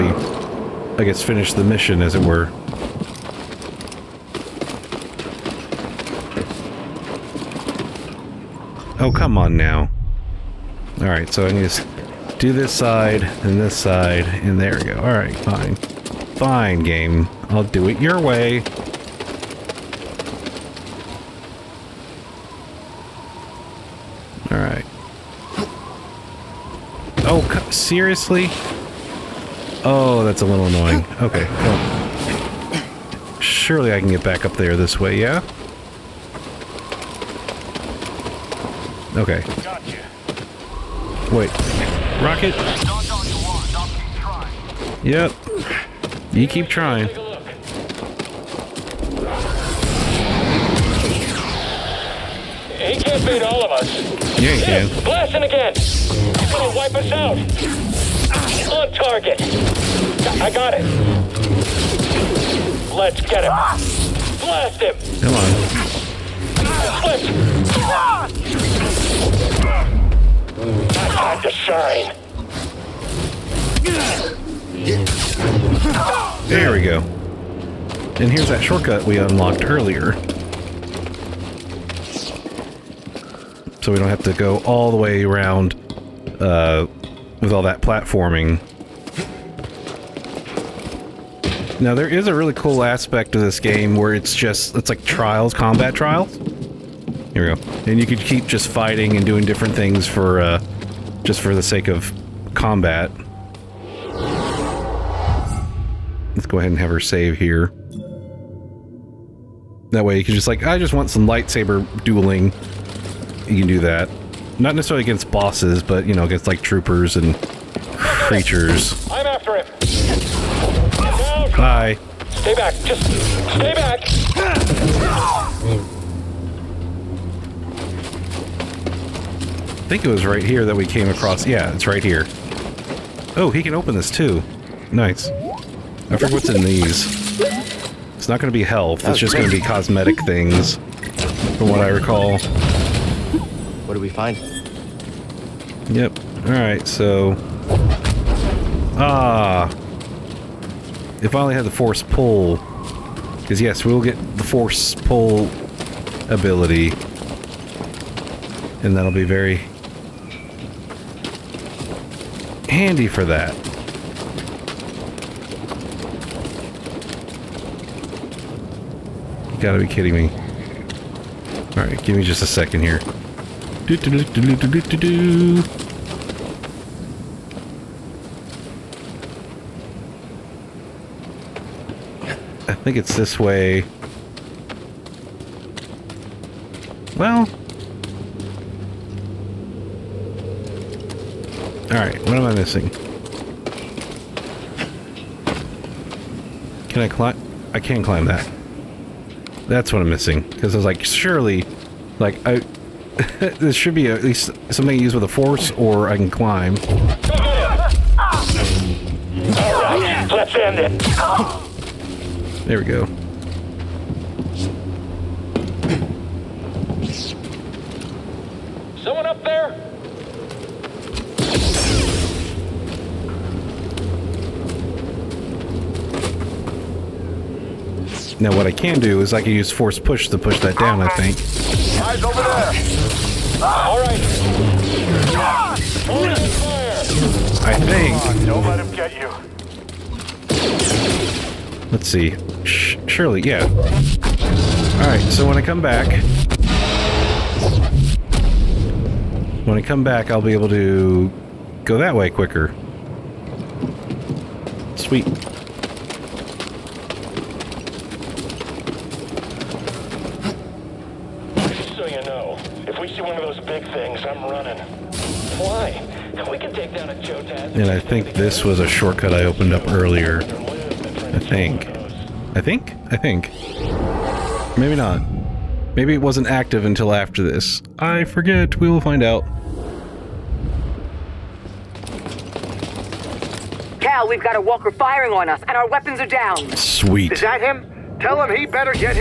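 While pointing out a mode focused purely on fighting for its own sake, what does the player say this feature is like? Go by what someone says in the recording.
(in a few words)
Combat trials.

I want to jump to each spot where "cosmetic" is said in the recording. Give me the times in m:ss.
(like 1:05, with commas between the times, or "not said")
2:19.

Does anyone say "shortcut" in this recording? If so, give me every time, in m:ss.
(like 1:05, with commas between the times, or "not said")
1:18, 4:28.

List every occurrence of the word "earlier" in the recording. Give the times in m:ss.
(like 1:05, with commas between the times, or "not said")
1:19, 4:29.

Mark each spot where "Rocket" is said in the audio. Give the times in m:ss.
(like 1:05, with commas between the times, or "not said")
0:42.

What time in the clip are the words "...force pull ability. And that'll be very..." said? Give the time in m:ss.
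2:34.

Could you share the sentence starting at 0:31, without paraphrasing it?
Okay, well, Surely I can get back up there this way, yeah?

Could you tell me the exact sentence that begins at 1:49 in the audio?
That way you can just like, I just want some lightsaber dueling.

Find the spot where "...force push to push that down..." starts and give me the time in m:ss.
3:49.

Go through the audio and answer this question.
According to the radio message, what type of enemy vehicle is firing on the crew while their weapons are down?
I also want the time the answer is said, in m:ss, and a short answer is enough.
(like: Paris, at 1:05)
Walker, at 4:44.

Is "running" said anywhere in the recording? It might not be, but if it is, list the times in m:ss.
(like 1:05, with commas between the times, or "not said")
4:24.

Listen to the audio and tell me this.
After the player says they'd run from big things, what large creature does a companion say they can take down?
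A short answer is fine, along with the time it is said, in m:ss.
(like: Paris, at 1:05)
Jotaz, at 4:27.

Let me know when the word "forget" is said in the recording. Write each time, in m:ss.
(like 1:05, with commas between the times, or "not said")
2:16, 4:38.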